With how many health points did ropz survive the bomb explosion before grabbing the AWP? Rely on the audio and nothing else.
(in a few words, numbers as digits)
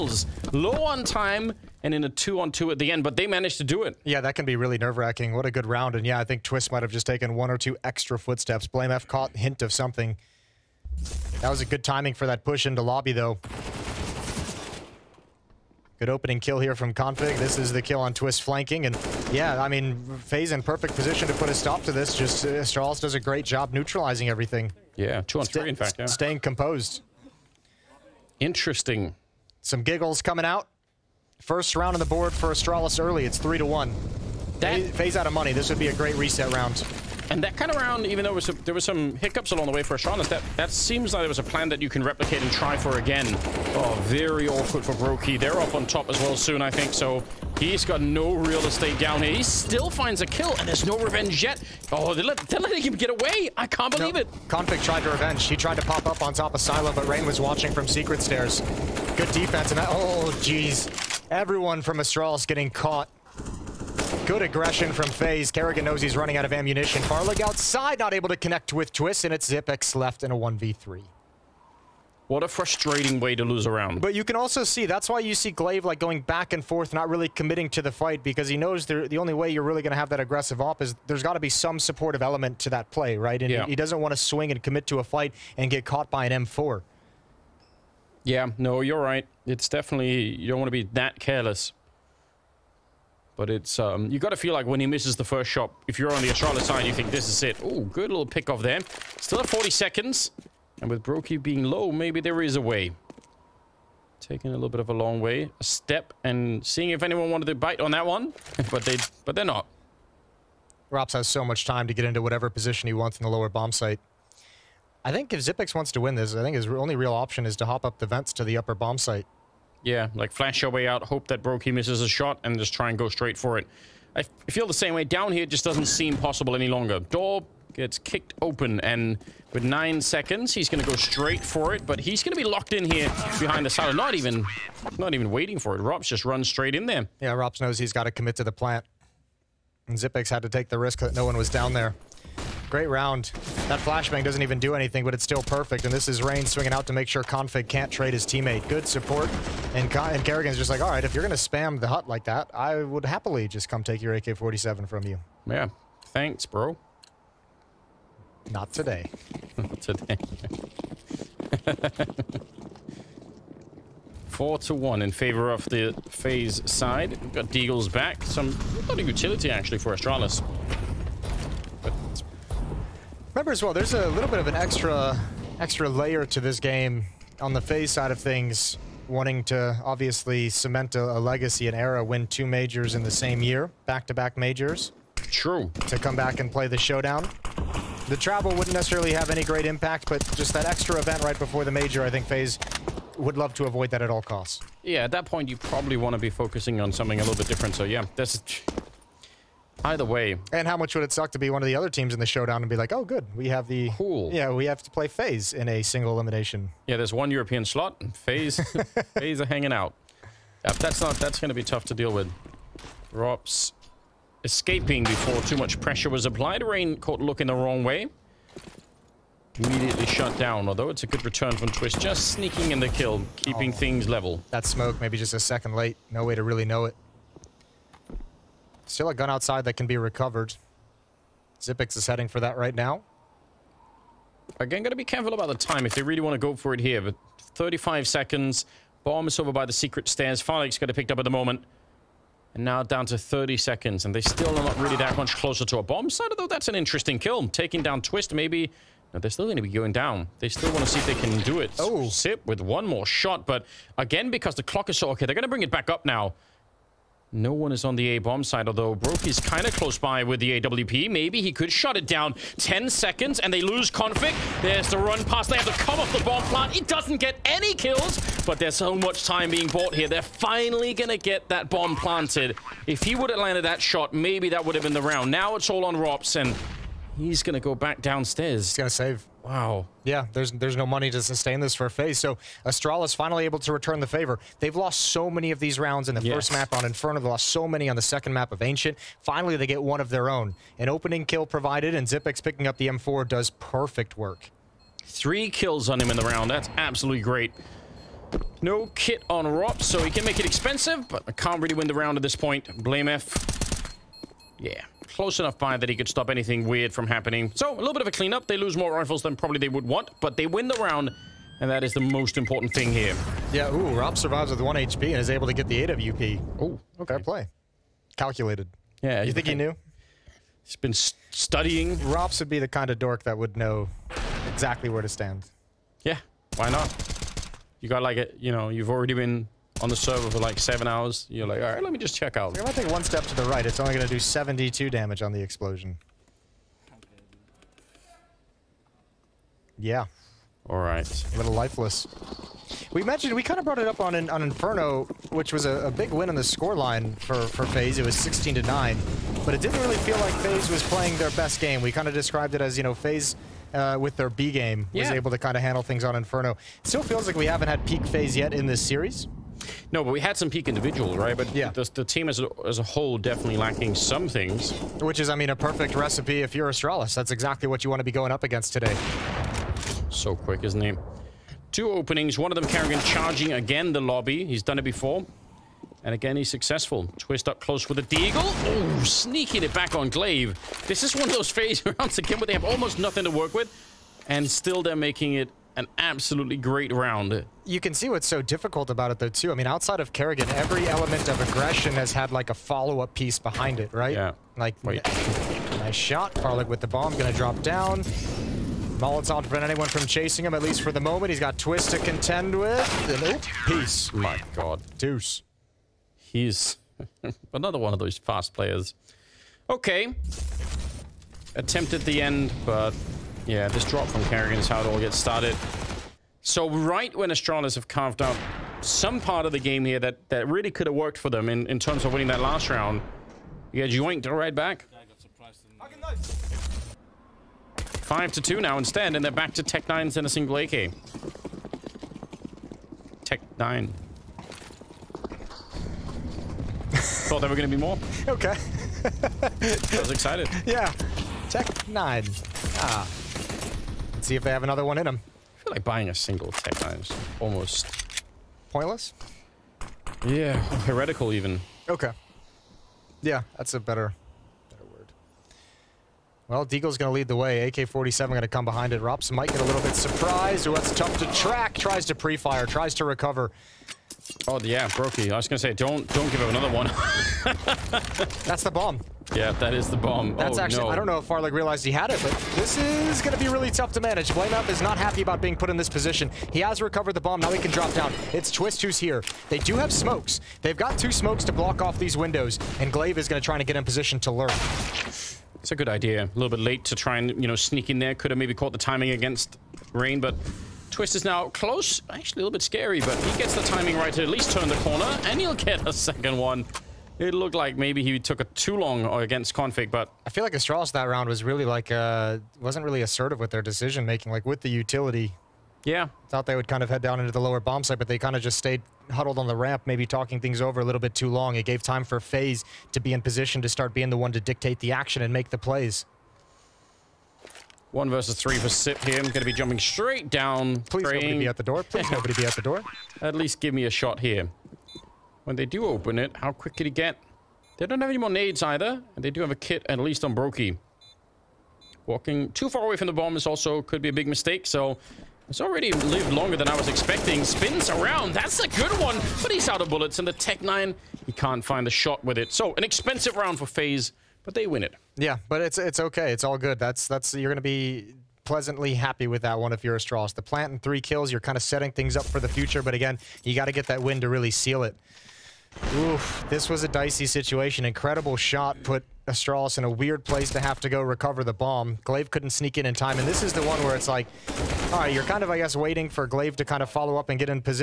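1.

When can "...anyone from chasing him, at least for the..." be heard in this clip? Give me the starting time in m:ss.
6:39.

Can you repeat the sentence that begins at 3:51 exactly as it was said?
Zipix is heading for that right now.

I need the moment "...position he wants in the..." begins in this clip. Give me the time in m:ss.
1:52.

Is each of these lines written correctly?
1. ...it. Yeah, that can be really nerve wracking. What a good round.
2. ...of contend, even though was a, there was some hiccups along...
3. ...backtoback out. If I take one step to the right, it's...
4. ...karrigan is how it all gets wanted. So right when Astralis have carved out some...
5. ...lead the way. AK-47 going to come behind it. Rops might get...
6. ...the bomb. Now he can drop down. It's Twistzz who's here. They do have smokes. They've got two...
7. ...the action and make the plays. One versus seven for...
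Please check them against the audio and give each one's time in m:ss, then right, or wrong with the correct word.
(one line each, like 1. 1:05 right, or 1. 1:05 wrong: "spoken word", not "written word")
1. 0:03 right
2. 0:37 wrong: "round", not "contend"
3. 5:32 wrong: "check", not "backtoback"
4. 6:54 wrong: "started", not "wanted"
5. 7:37 right
6. 7:57 right
7. 8:34 wrong: "three", not "seven".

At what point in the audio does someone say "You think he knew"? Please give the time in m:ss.
5:19.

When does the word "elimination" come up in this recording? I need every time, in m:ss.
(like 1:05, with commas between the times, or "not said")
3:26.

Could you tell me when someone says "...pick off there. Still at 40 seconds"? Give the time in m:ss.
1:38.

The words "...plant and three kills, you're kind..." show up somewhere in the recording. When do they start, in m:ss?
9:10.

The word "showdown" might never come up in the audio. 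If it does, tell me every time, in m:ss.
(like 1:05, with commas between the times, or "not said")
3:06, 3:22.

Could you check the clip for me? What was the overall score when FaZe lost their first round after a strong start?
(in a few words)
3 to 1.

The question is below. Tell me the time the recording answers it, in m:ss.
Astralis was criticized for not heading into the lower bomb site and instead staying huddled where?
8:29.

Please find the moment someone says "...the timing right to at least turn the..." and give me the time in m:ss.
8:13.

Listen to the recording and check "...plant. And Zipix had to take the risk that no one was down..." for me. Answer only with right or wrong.
right.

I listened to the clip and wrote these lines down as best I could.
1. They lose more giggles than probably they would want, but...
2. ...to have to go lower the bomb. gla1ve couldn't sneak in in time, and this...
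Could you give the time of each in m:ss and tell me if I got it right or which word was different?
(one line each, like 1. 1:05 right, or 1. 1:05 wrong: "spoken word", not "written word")
1. 5:08 wrong: "rifles", not "giggles"
2. 9:20 wrong: "recover", not "lower".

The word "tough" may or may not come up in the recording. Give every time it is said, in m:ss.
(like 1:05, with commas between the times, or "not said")
3:31, 7:40, 7:53.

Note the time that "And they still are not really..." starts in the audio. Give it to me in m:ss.
4:04.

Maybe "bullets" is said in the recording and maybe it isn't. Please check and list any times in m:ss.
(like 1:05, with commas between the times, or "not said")
8:59.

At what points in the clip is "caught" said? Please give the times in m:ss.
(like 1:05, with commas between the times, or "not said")
0:09, 1:02, 1:25, 3:36, 8:08.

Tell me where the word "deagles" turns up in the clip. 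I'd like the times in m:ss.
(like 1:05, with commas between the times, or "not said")
2:47, 6:18, 7:36.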